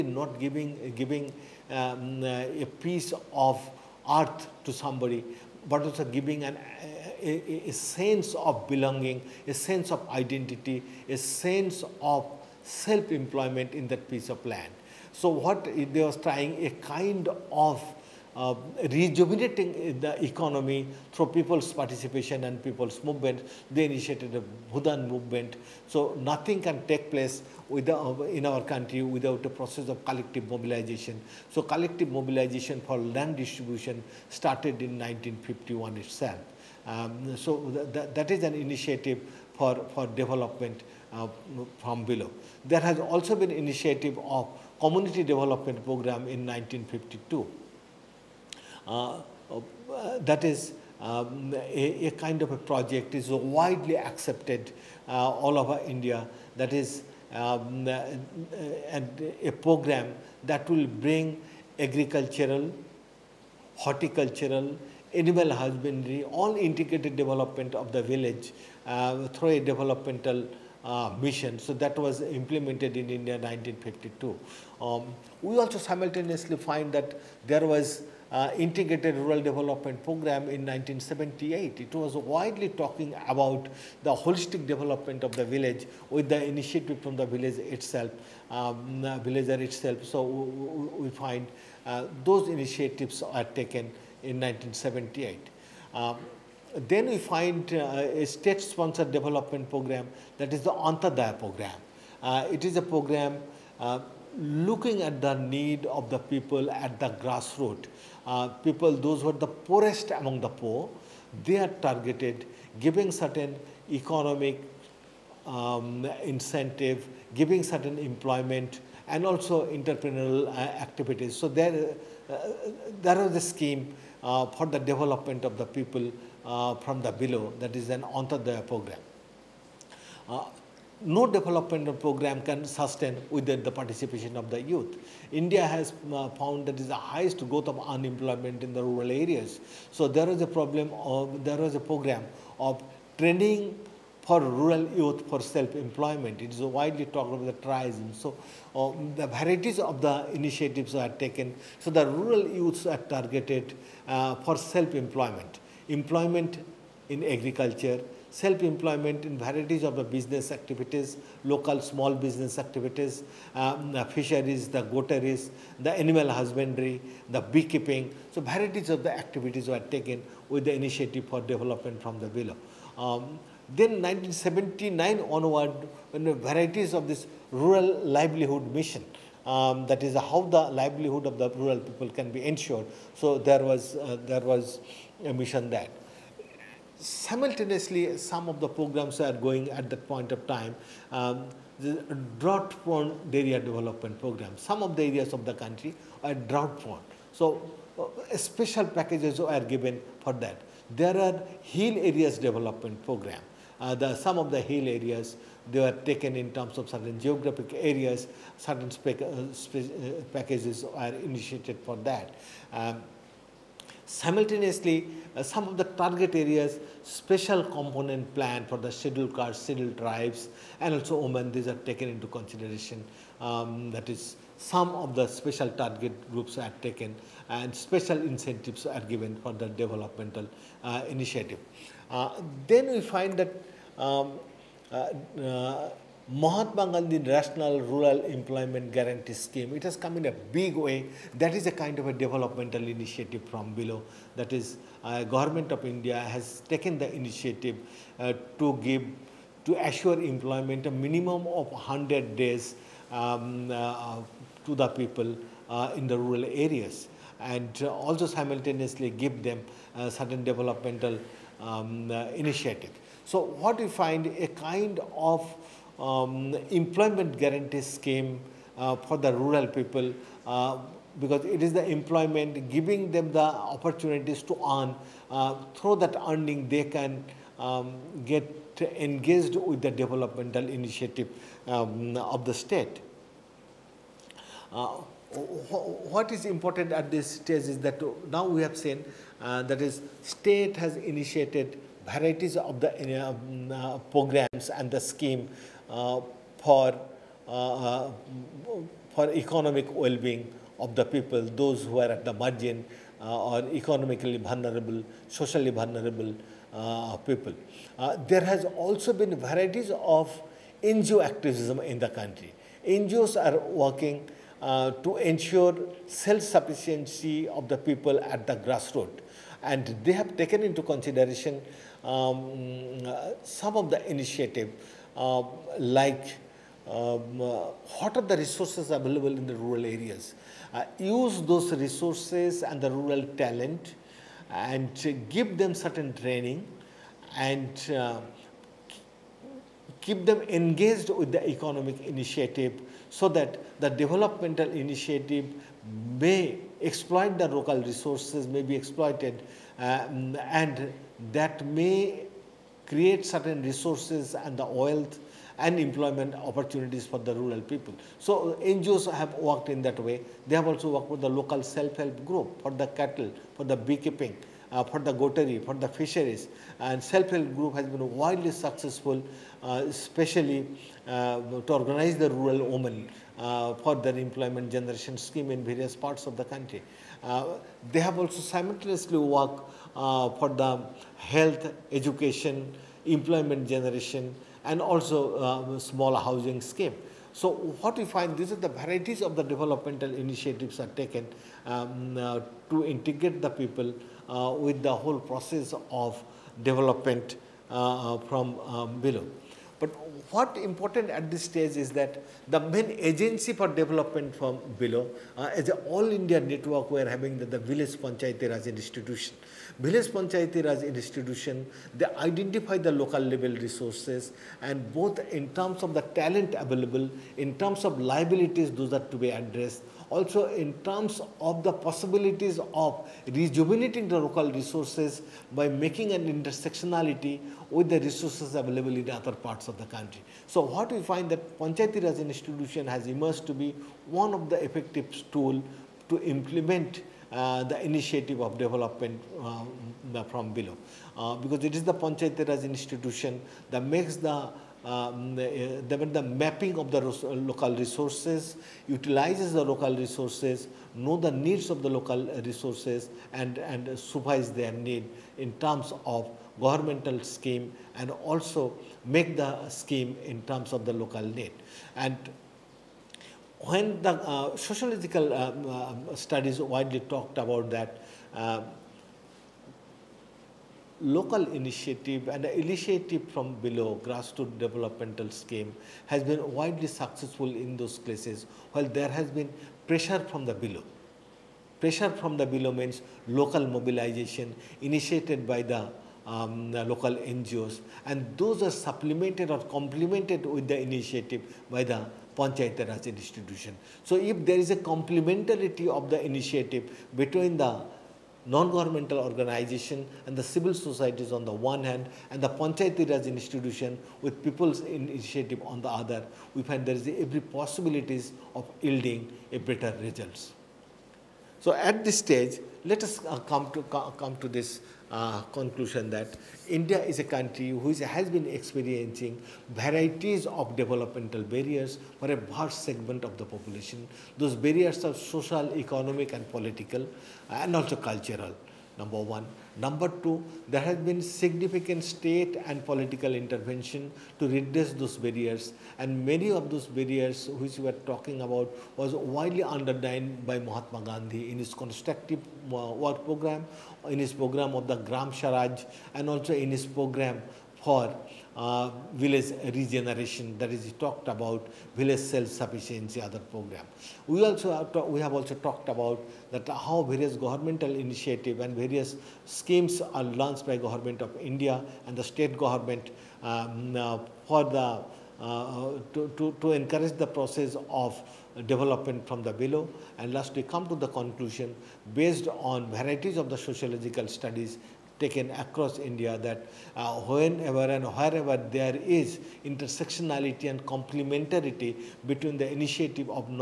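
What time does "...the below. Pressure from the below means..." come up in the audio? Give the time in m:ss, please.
8:00.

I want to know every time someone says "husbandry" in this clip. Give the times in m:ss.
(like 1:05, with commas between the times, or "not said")
1:05, 2:46.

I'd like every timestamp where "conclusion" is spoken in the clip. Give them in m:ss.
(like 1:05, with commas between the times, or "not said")
8:35, 9:31.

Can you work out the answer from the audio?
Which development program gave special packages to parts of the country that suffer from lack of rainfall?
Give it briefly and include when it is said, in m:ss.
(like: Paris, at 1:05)
drought prone area development program, at 3:12.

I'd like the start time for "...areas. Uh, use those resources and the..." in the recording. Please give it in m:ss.
5:29.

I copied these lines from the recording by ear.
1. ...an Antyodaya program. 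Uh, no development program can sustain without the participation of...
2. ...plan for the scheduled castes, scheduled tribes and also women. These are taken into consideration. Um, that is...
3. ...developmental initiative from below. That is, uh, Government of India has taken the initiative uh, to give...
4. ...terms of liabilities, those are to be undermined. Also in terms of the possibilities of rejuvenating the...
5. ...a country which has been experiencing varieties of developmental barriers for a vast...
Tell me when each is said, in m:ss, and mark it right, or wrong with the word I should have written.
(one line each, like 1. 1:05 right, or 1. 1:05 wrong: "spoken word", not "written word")
1. 2:07 right
2. 3:38 right
3. 4:02 right
4. 6:57 wrong: "addressed", not "undermined"
5. 8:37 right.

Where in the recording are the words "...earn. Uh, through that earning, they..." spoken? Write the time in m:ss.
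4:34.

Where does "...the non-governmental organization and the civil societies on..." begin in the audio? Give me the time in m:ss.
8:17.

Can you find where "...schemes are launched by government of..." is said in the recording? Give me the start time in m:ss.
9:19.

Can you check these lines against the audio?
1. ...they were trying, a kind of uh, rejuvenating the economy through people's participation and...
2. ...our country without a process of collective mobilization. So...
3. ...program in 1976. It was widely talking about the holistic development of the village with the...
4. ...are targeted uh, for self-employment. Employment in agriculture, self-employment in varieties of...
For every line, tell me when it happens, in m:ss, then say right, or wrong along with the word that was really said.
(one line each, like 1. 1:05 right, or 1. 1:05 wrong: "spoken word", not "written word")
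1. 0:15 right
2. 0:28 right
3. 1:20 wrong: "1978", not "1976"
4. 2:32 right.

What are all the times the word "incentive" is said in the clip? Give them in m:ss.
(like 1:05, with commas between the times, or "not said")
1:56, 3:48.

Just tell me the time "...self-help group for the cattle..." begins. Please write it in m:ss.
6:01.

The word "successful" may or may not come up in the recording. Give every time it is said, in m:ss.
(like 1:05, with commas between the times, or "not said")
6:08, 7:56.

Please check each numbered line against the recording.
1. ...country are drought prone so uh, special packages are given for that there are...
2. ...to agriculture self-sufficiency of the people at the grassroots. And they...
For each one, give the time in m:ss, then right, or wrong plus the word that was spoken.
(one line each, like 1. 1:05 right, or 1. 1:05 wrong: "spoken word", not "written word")
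1. 3:15 right
2. 5:15 wrong: "ensure", not "agriculture".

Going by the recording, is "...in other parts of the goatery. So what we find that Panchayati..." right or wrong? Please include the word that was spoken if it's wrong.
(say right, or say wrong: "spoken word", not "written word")
wrong: "country", not "goatery".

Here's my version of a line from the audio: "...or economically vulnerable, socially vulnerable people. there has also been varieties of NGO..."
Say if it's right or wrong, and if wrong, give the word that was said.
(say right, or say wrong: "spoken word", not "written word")
right.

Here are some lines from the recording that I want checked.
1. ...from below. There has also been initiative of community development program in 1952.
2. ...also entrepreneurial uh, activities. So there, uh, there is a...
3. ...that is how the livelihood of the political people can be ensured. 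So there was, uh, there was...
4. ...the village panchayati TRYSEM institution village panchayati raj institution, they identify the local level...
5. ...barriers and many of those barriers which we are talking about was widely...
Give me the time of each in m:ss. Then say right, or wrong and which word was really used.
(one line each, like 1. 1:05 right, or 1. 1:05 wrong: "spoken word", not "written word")
1. 0:41 right
2. 1:59 right
3. 2:59 wrong: "rural", not "political"
4. 6:47 wrong: "Raj", not "TRYSEM"
5. 8:55 right.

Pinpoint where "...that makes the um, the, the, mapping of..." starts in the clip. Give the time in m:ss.
7:23.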